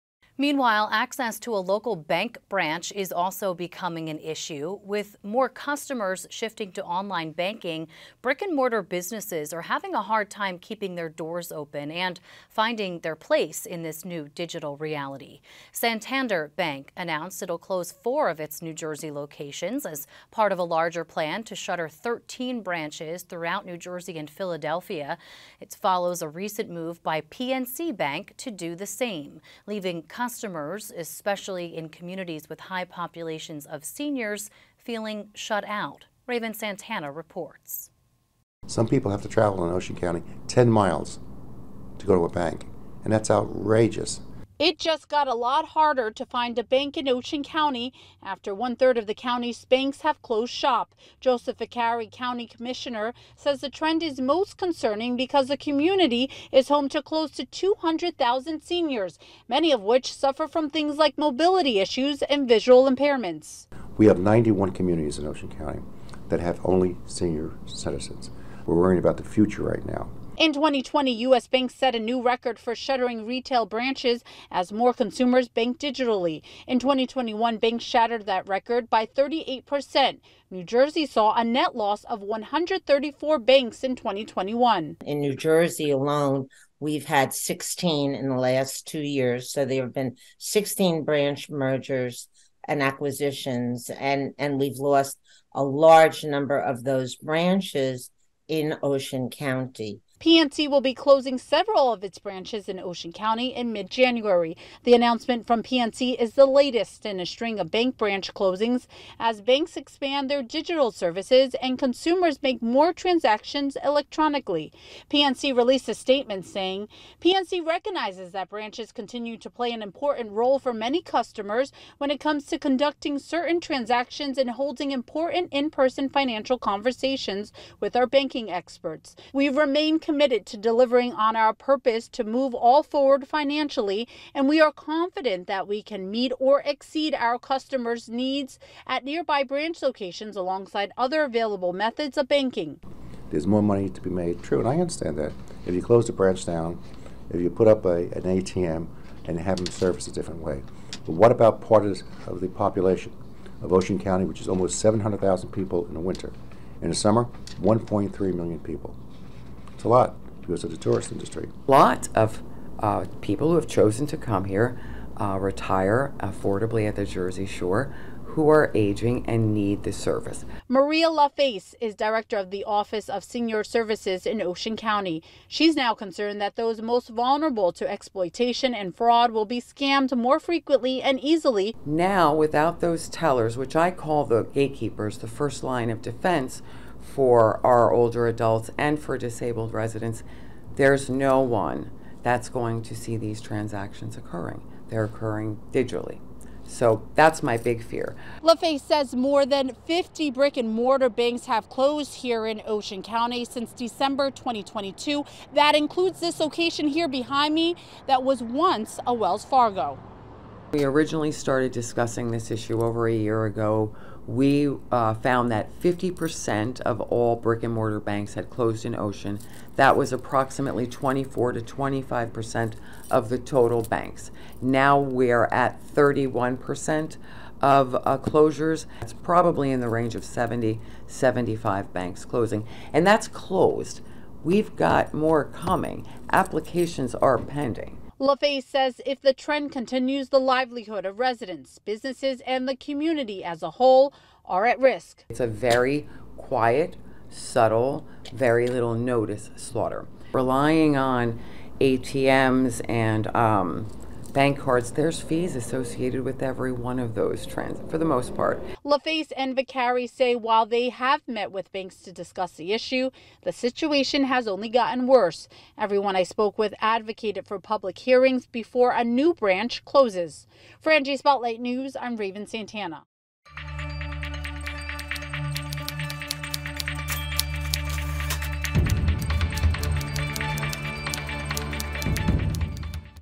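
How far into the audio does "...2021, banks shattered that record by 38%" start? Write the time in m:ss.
1:16.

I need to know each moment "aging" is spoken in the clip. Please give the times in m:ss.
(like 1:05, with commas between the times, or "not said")
2:48.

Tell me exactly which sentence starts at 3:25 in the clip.
That includes this location here behind me that was once a Wells Fargo.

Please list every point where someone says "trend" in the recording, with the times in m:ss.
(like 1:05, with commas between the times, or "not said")
0:53, 3:59, 4:17.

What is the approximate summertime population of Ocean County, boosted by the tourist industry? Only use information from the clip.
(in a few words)
1.3 million.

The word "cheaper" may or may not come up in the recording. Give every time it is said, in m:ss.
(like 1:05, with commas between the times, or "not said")
not said.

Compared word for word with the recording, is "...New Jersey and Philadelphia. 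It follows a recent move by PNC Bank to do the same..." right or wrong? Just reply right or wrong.
right.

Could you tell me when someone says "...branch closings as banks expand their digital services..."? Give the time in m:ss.
1:47.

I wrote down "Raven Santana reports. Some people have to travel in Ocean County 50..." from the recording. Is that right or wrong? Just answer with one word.
wrong.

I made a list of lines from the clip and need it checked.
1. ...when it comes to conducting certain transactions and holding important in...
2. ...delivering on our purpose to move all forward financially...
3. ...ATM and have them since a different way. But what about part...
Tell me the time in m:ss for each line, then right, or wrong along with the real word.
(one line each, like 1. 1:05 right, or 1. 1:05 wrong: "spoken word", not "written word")
1. 2:01 right
2. 2:10 right
3. 2:28 wrong: "service", not "since".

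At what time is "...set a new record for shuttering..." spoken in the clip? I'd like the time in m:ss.
1:11.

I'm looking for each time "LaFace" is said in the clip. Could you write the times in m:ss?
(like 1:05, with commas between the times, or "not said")
2:51, 3:18, 3:58, 4:18.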